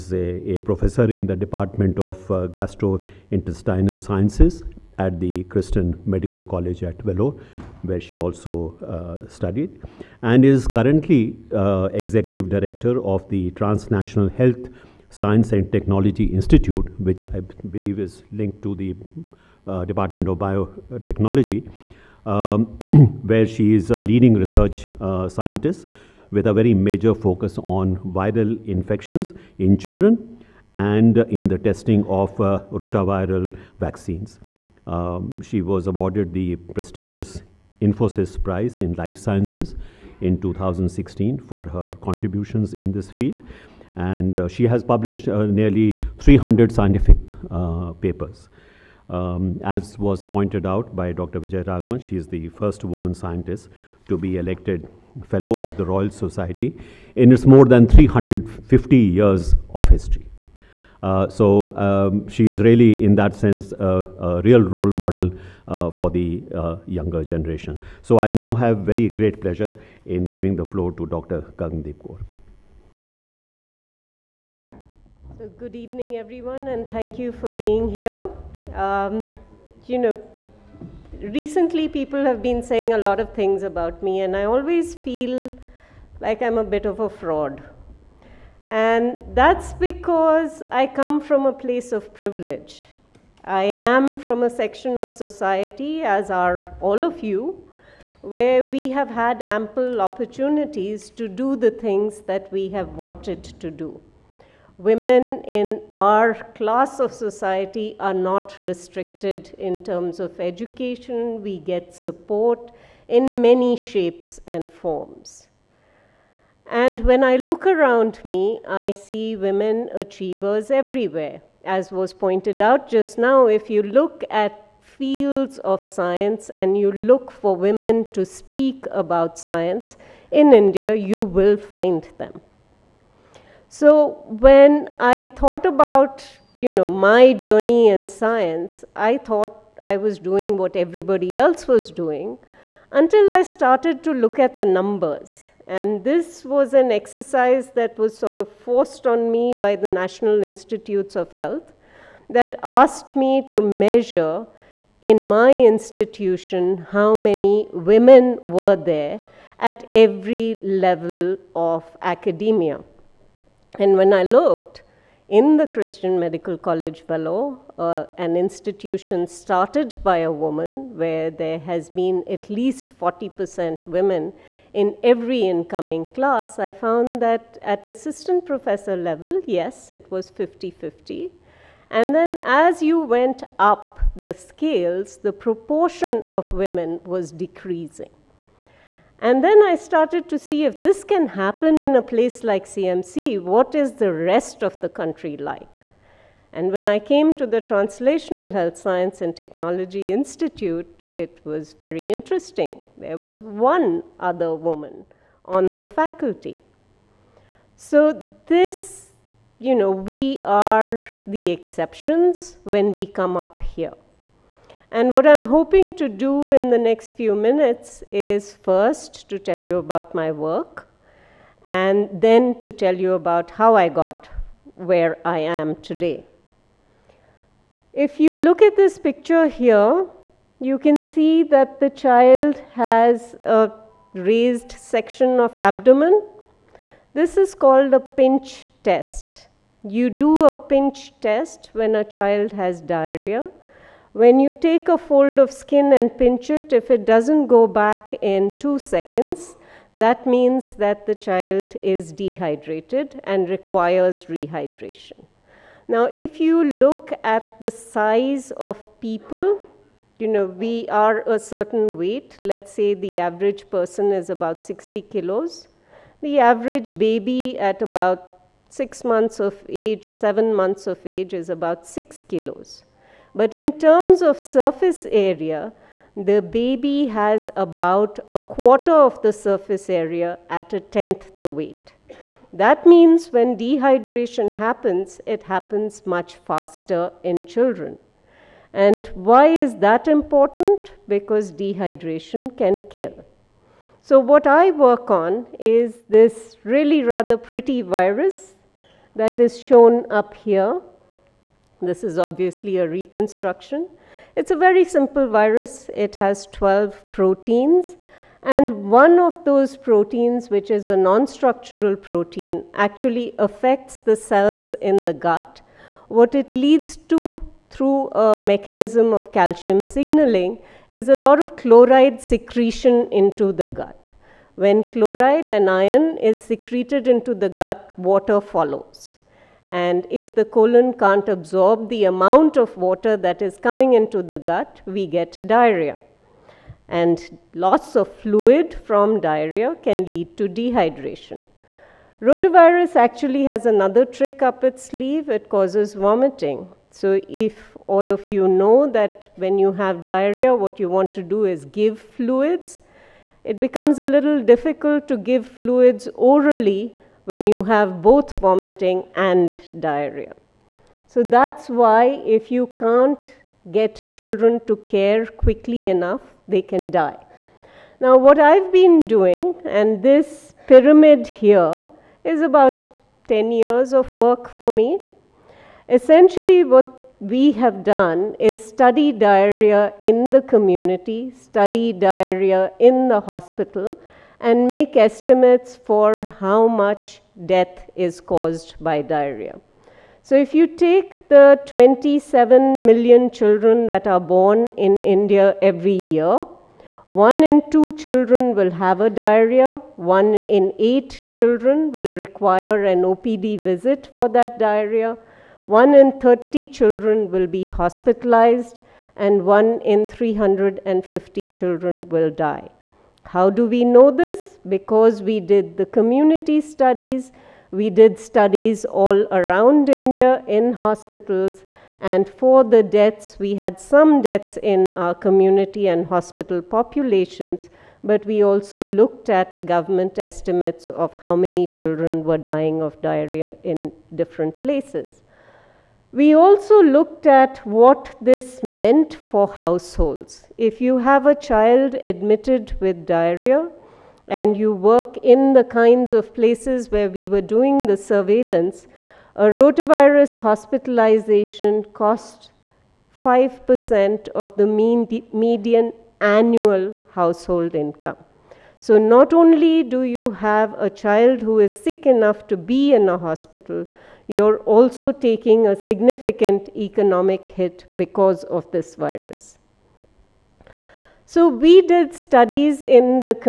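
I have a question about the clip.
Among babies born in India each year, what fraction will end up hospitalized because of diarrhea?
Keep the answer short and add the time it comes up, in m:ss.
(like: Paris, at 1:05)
1 in 30, at 6:45.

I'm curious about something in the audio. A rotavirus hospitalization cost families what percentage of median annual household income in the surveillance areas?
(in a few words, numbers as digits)
5%.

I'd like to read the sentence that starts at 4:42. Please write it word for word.
That means when dehydration happens, it happens much faster in children.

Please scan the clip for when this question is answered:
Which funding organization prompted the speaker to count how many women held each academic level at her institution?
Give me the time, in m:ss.
2:29.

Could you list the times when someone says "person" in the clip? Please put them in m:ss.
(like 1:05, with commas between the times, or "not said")
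4:23.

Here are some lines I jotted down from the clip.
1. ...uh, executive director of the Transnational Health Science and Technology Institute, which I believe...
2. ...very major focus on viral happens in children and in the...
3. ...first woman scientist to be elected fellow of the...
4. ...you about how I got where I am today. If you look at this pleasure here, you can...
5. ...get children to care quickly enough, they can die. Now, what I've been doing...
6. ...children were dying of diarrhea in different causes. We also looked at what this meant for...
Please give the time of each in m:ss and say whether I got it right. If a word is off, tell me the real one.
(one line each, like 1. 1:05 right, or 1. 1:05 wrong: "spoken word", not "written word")
1. 0:11 right
2. 0:26 wrong: "infections", not "happens"
3. 0:52 right
4. 3:42 wrong: "picture", not "pleasure"
5. 6:03 right
6. 7:11 wrong: "places", not "causes".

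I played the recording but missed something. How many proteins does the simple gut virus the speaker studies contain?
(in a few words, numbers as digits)
12.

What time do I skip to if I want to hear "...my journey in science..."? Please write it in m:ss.
2:16.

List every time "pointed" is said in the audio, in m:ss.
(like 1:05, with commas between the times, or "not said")
0:50, 2:02.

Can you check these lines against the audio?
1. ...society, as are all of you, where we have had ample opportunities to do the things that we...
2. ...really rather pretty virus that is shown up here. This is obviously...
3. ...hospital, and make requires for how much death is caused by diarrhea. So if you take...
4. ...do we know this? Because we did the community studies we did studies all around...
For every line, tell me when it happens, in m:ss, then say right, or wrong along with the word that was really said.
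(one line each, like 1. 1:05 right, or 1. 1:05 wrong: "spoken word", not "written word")
1. 1:35 right
2. 4:56 right
3. 6:23 wrong: "estimates", not "requires"
4. 6:53 right.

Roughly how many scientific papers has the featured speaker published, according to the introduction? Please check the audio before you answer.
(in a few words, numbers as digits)
nearly 300.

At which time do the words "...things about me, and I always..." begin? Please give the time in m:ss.
1:23.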